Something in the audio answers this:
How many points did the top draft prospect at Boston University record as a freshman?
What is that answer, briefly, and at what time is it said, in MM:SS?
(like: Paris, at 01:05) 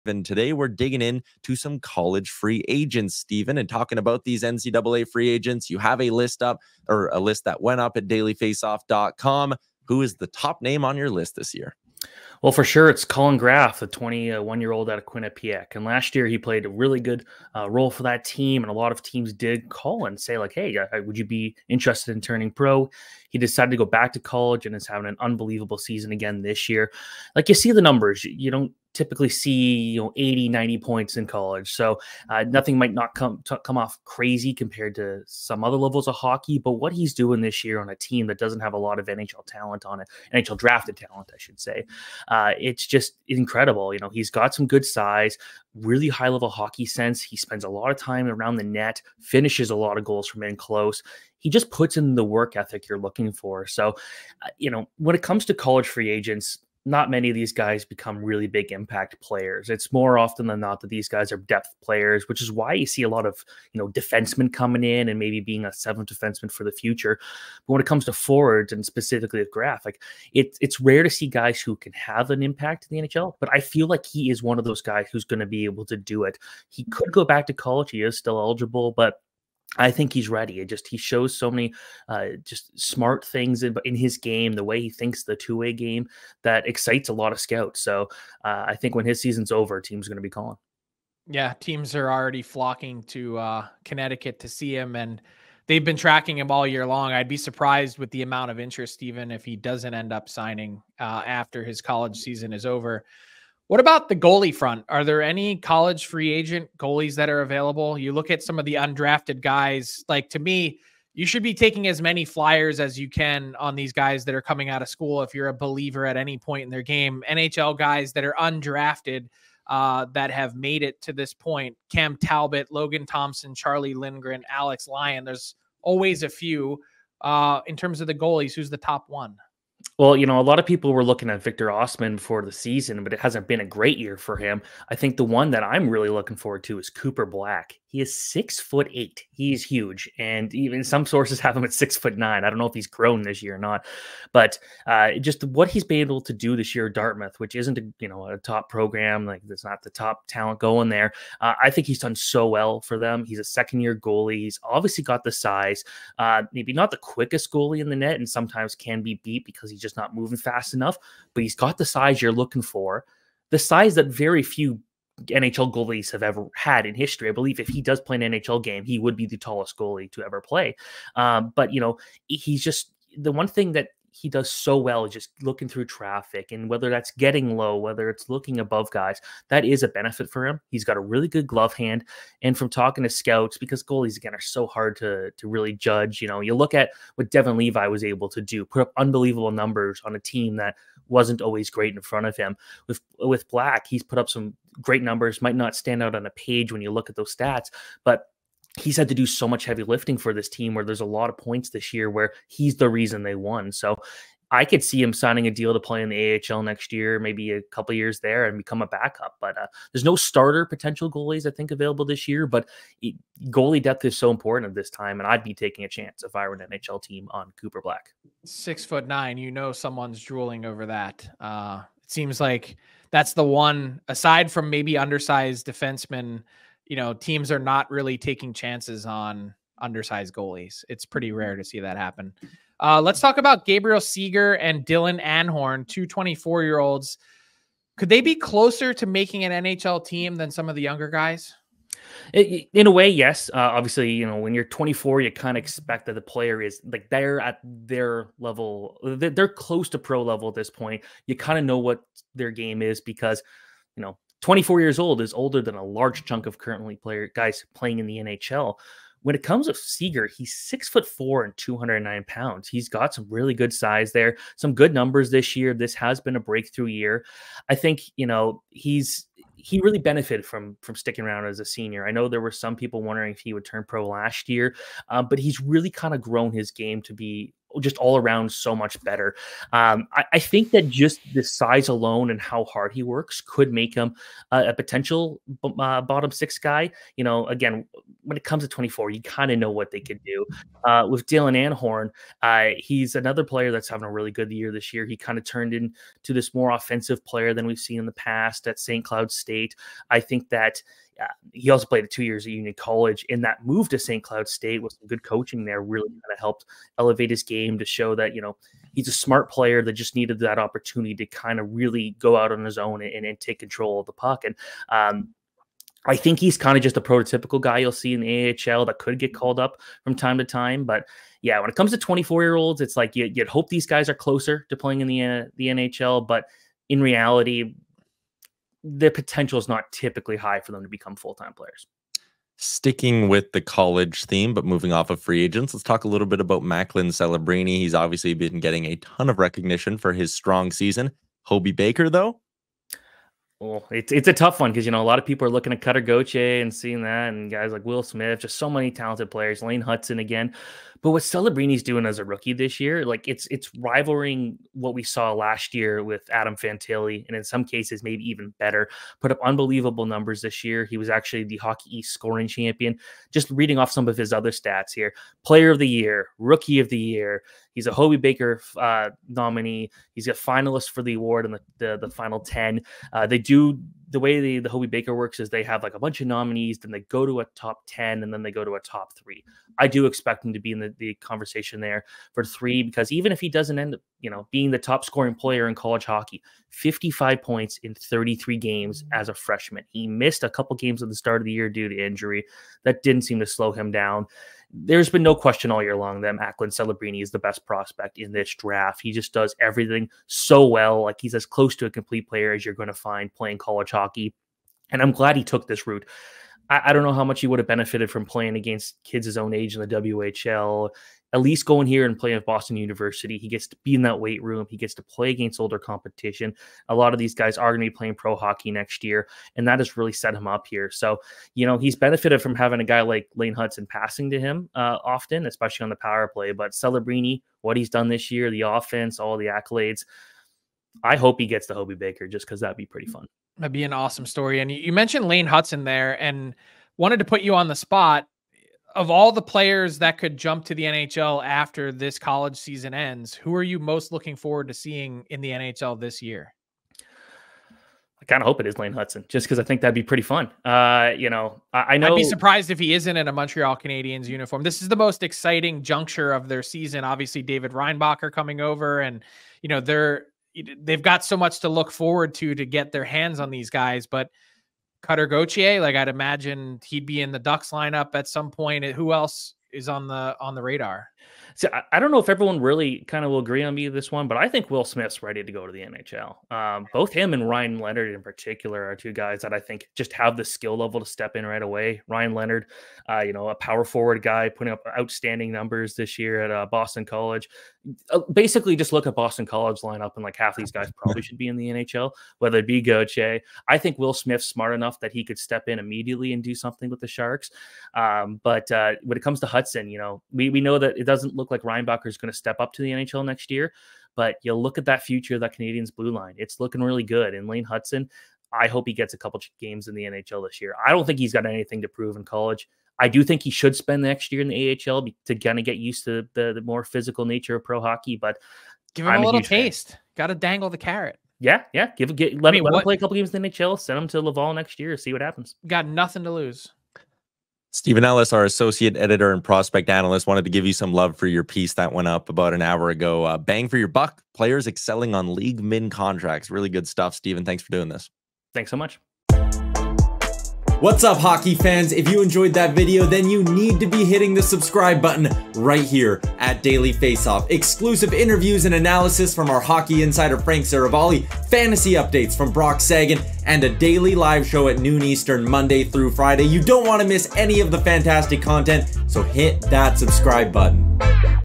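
55, at 06:26.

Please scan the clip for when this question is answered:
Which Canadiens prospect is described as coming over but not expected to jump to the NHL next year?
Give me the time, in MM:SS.
07:37.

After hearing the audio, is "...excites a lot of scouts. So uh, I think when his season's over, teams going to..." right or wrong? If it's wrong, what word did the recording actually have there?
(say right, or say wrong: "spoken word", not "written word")
right.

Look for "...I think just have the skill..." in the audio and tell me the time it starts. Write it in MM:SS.
07:59.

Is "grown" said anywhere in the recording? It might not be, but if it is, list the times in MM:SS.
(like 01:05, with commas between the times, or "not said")
02:22, 04:36.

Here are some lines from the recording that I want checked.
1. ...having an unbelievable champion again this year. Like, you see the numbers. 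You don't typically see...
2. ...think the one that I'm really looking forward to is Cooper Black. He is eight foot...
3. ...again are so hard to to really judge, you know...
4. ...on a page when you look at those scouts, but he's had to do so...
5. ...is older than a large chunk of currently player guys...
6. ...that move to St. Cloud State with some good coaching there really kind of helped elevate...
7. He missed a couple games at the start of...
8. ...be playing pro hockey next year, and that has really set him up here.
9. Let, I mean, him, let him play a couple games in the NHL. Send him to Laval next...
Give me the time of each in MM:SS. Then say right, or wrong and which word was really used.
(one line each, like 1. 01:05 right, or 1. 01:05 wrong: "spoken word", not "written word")
1. 00:24 wrong: "season", not "champion"
2. 02:14 wrong: "six", not "eight"
3. 03:04 right
4. 03:16 wrong: "stats", not "scouts"
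5. 04:15 right
6. 05:03 right
7. 06:29 right
8. 06:57 right
9. 08:42 right.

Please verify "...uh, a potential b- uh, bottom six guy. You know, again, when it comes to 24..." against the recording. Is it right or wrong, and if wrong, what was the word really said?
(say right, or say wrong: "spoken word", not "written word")
right.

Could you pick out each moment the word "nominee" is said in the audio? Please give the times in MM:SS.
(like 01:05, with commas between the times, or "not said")
06:09, 06:16.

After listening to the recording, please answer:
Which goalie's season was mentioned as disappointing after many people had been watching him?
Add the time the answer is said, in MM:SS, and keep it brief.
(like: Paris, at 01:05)
Victor Ostman, at 02:11.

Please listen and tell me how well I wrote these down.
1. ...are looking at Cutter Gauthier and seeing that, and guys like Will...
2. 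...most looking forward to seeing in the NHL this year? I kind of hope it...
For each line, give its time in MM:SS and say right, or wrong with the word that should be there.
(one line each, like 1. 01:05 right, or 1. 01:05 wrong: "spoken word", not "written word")
1. 05:45 right
2. 07:23 right.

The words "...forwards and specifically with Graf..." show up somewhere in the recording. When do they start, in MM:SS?
01:08.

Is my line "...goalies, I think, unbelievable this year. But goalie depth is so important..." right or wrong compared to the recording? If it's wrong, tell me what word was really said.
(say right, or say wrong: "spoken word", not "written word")
wrong: "available", not "unbelievable".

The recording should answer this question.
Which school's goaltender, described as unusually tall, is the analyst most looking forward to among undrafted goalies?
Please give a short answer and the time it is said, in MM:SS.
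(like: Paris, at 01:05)
Dartmouth, at 02:26.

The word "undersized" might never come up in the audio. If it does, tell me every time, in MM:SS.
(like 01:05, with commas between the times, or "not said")
03:44, 03:49.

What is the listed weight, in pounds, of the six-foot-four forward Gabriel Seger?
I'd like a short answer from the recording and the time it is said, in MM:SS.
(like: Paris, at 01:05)
209, at 04:21.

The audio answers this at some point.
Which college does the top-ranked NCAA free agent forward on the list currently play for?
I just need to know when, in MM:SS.
00:15.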